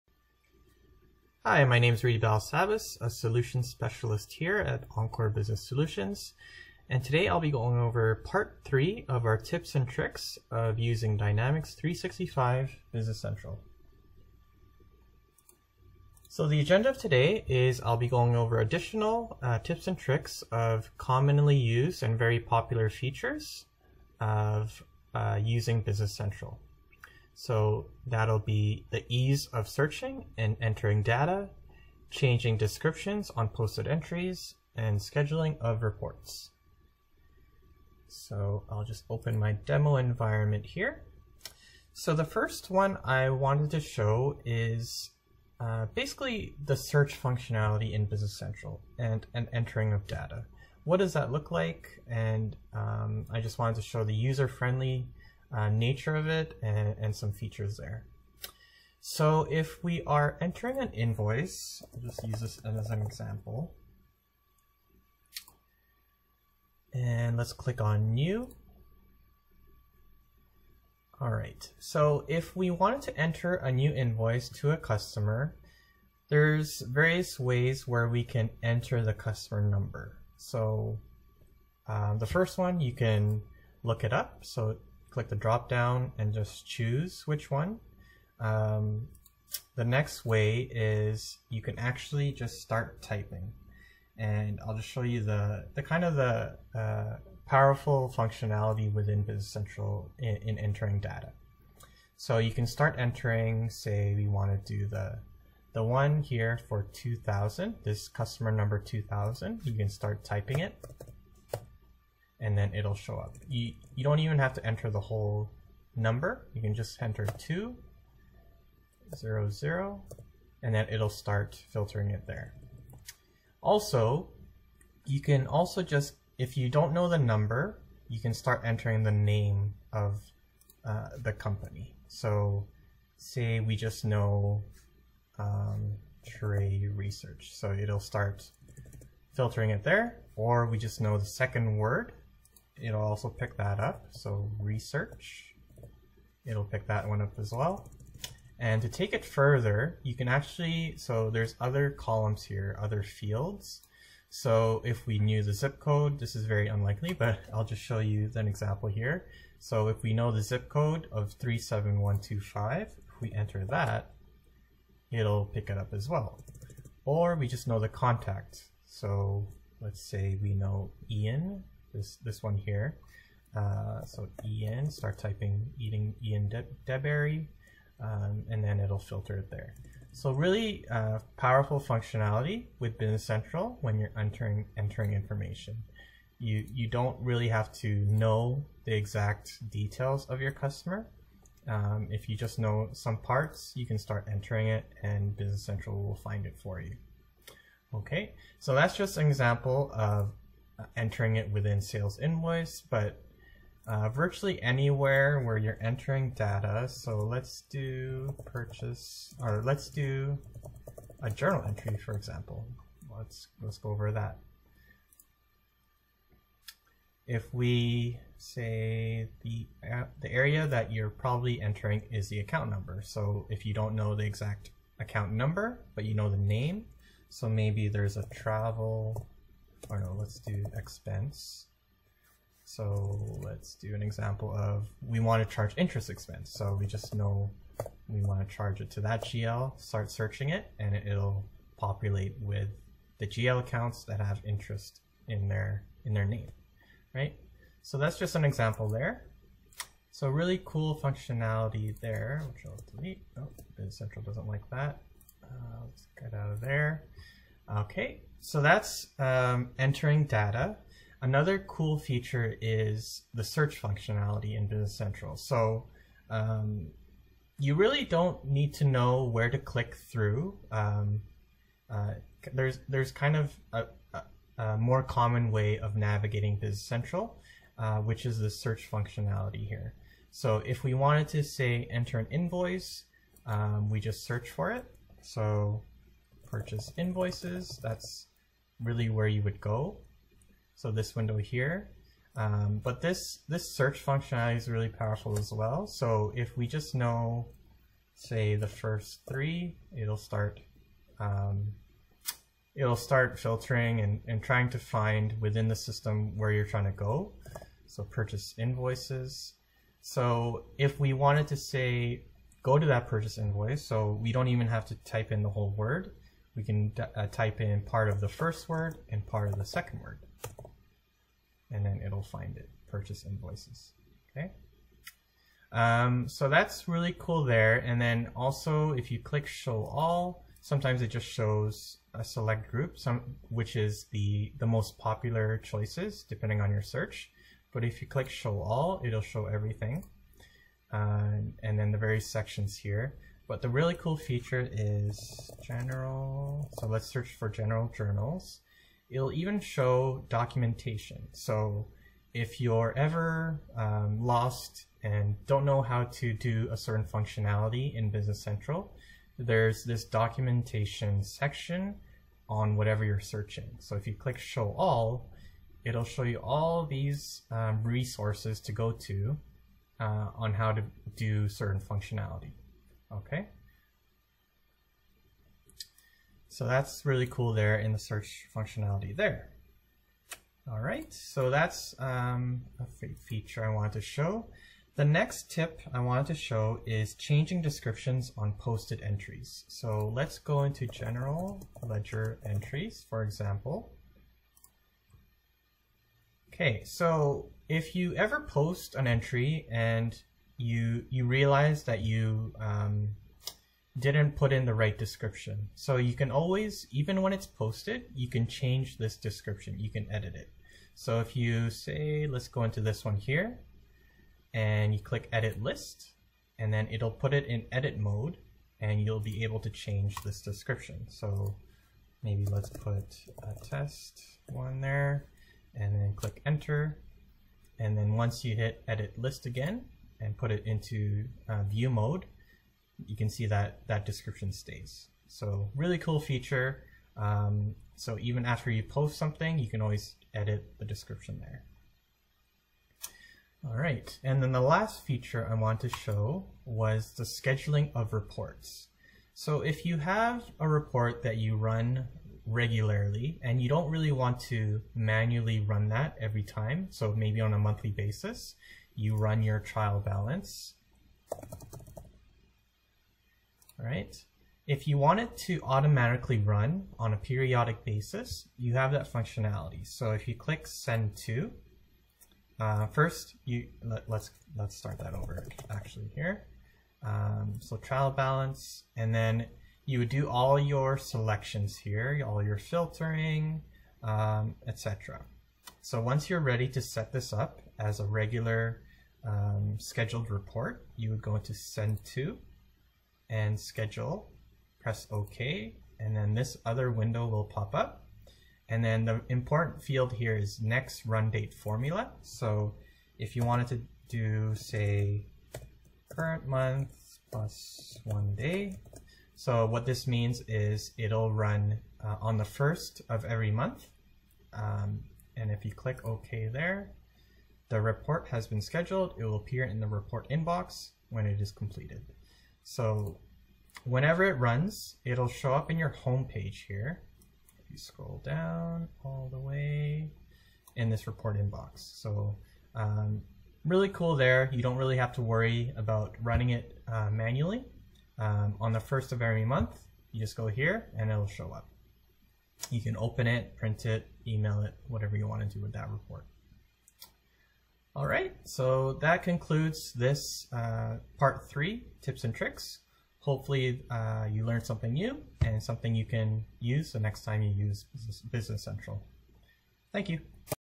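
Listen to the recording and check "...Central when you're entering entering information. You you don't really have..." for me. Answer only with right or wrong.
right.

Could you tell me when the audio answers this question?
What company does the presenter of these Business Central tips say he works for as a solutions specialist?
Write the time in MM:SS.
00:04.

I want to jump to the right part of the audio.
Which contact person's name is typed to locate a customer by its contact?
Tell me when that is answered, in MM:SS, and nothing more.
02:56.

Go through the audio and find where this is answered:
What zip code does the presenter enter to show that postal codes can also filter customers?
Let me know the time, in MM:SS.
02:41.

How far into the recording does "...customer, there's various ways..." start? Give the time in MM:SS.
01:14.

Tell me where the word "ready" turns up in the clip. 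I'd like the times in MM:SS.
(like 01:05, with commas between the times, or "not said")
08:06.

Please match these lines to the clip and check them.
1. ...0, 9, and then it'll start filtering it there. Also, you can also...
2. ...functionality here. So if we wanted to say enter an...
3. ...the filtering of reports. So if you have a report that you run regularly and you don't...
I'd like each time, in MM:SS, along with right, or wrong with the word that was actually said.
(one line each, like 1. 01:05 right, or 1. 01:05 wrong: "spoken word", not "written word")
1. 01:59 wrong: "0", not "9"
2. 04:38 right
3. 07:27 wrong: "scheduling", not "filtering".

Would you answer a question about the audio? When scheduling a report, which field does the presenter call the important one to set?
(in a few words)
next run date formula.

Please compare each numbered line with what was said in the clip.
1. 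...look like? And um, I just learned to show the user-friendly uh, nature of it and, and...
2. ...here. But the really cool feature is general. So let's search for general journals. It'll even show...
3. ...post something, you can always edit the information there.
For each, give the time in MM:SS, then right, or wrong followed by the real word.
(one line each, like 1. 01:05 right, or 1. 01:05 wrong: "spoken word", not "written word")
1. 00:51 wrong: "wanted", not "learned"
2. 05:42 right
3. 07:18 wrong: "description", not "information".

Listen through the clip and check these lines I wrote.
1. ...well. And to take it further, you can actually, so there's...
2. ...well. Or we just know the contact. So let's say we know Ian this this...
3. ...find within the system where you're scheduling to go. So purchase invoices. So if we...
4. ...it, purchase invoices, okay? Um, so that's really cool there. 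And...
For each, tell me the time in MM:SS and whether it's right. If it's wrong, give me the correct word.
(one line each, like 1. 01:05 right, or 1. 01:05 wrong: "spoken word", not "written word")
1. 02:27 right
2. 02:46 right
3. 05:04 wrong: "trying", not "scheduling"
4. 05:22 right.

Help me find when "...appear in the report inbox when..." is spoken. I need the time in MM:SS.
08:39.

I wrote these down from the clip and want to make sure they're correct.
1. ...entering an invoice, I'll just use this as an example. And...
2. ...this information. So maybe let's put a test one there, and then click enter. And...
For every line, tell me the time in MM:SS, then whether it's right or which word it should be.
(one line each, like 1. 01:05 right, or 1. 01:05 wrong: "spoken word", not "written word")
1. 01:00 right
2. 07:00 wrong: "description", not "information".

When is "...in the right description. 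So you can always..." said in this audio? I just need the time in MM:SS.
06:44.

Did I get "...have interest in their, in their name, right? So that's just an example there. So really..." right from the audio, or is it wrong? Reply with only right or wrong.
right.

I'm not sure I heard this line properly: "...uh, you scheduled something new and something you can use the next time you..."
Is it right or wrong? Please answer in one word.
wrong.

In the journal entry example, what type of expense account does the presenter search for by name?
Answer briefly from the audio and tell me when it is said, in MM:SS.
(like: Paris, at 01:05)
interest expense, at 03:55.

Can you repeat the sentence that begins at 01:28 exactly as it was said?
Um, the next way is you can actually just start typing.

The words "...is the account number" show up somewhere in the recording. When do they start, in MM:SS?
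03:42.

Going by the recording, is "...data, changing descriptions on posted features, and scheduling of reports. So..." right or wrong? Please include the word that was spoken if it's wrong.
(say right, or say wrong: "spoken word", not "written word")
wrong: "entries", not "features".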